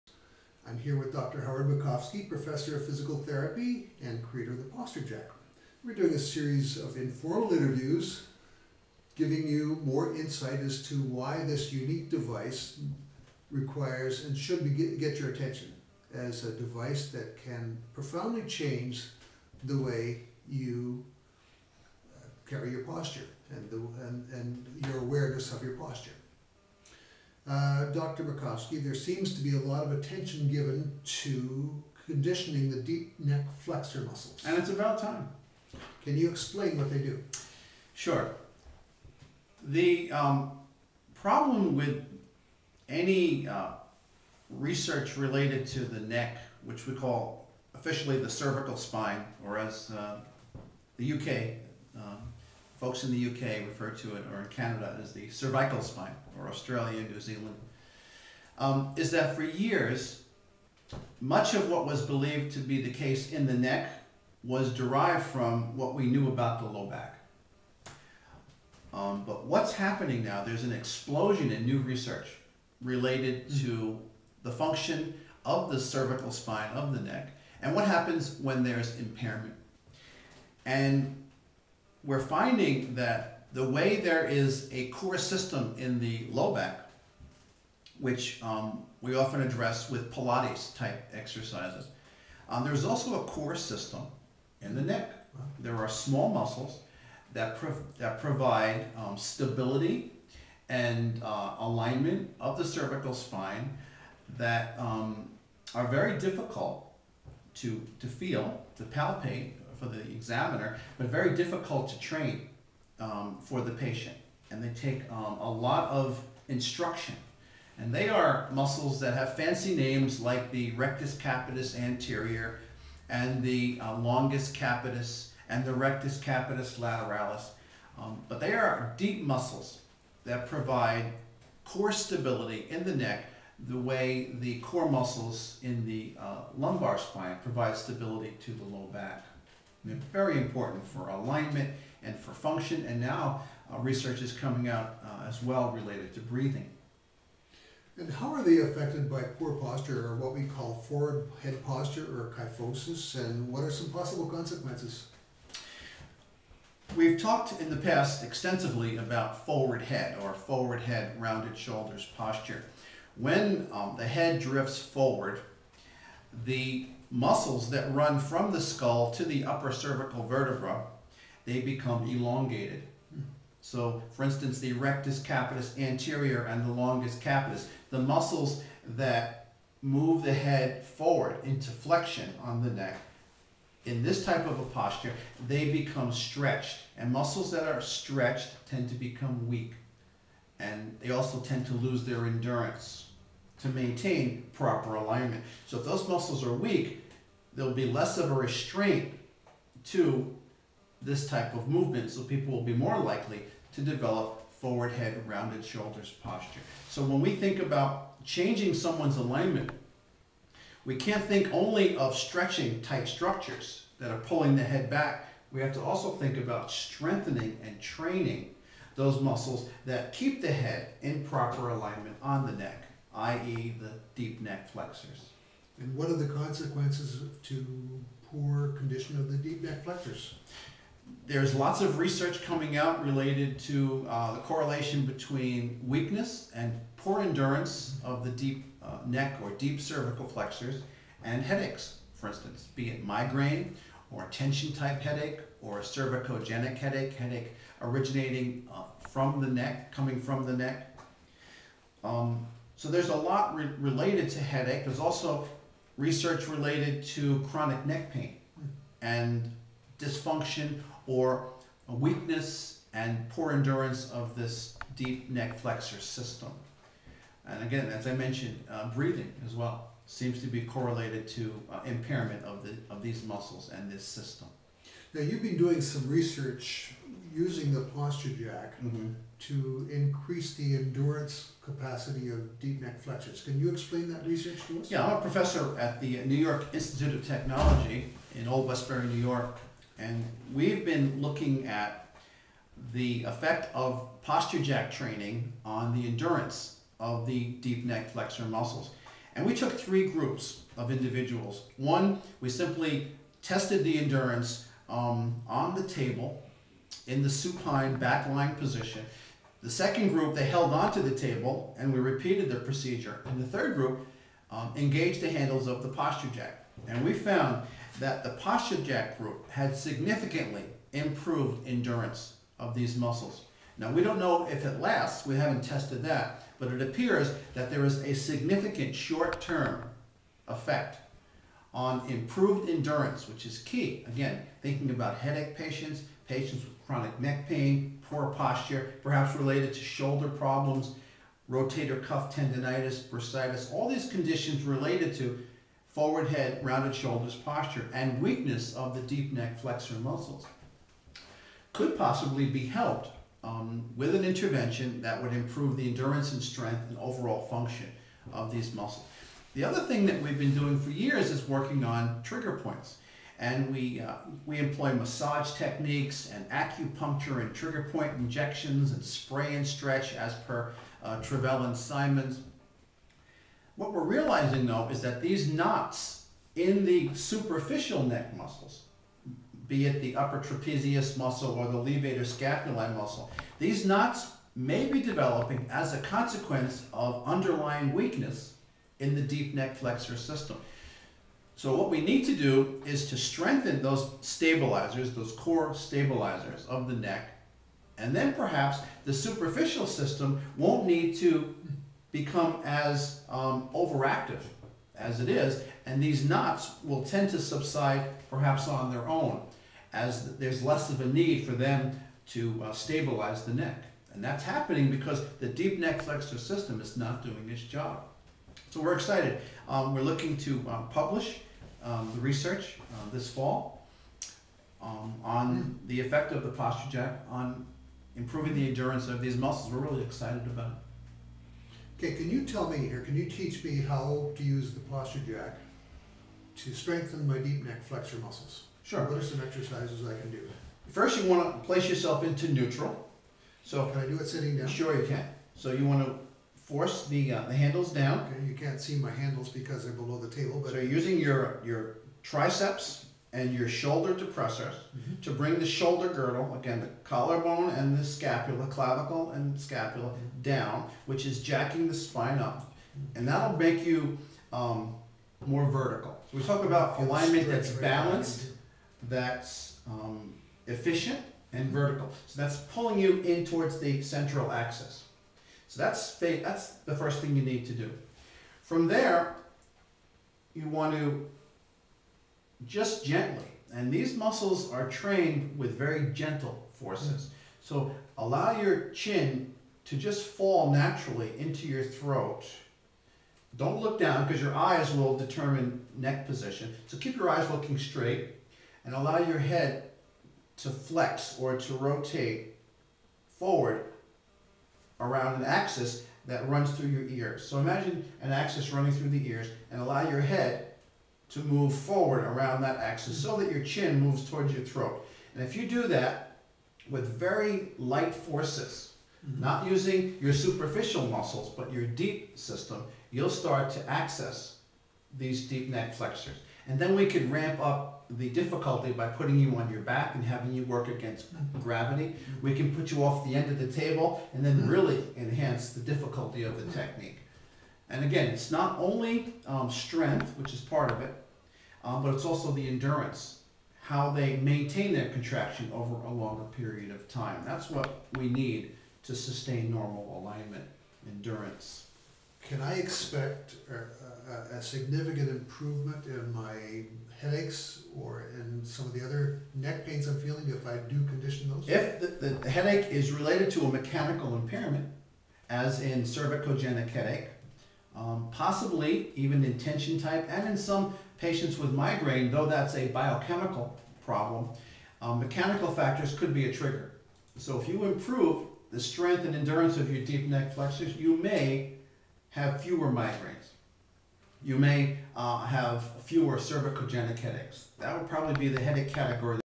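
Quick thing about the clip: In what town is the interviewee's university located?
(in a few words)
Old Westbury.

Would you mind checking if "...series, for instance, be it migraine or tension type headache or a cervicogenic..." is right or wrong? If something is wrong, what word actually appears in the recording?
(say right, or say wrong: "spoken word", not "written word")
wrong: "headaches", not "series".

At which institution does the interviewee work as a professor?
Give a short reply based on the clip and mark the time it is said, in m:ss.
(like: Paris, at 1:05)
New York Institute of Technology, at 4:46.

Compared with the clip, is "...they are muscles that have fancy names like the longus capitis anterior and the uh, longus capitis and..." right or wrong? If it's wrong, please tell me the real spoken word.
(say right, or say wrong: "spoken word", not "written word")
wrong: "rectus", not "longus".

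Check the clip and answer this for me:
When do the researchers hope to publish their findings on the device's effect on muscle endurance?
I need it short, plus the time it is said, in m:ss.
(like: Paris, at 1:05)
this fall, at 7:03.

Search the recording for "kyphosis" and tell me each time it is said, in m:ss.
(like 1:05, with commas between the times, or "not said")
2:32.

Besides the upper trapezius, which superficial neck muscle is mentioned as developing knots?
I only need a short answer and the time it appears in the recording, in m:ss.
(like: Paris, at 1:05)
levator scapulae, at 6:21.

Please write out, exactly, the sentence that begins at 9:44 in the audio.
You may uh, have fewer cervicogenic headaches.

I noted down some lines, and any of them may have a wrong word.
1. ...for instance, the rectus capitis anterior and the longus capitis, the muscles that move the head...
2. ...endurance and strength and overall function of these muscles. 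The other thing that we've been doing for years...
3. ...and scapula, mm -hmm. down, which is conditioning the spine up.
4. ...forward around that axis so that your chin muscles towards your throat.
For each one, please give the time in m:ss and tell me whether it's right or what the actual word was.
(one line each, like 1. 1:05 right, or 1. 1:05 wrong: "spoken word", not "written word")
1. 2:54 right
2. 5:55 right
3. 7:39 wrong: "jacking", not "conditioning"
4. 8:31 wrong: "moves", not "muscles".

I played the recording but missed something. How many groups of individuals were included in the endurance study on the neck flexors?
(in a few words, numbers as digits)
3.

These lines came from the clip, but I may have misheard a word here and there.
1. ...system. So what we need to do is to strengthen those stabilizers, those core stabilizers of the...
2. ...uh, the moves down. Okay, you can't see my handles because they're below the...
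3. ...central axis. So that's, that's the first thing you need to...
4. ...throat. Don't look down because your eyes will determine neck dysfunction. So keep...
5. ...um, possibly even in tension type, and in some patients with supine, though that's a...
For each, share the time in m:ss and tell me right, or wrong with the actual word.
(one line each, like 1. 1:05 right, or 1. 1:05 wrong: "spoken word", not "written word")
1. 6:30 right
2. 7:27 wrong: "handles", not "moves"
3. 7:54 right
4. 8:11 wrong: "position", not "dysfunction"
5. 9:27 wrong: "migraine", not "supine".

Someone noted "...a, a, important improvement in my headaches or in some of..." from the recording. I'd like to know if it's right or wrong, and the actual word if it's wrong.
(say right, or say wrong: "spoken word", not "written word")
wrong: "significant", not "important".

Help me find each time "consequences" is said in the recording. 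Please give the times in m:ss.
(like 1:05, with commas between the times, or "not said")
2:34, 3:46, 6:26.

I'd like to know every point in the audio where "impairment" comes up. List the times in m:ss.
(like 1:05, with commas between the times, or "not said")
1:18, 4:31, 9:24.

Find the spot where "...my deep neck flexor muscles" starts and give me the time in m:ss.
7:17.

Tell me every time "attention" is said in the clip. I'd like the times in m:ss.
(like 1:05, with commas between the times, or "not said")
0:15, 0:29.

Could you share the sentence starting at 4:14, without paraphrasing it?
There's also research related to chronic neck pain and dysfunction or weakness and poor endurance of this deep neck flexor system.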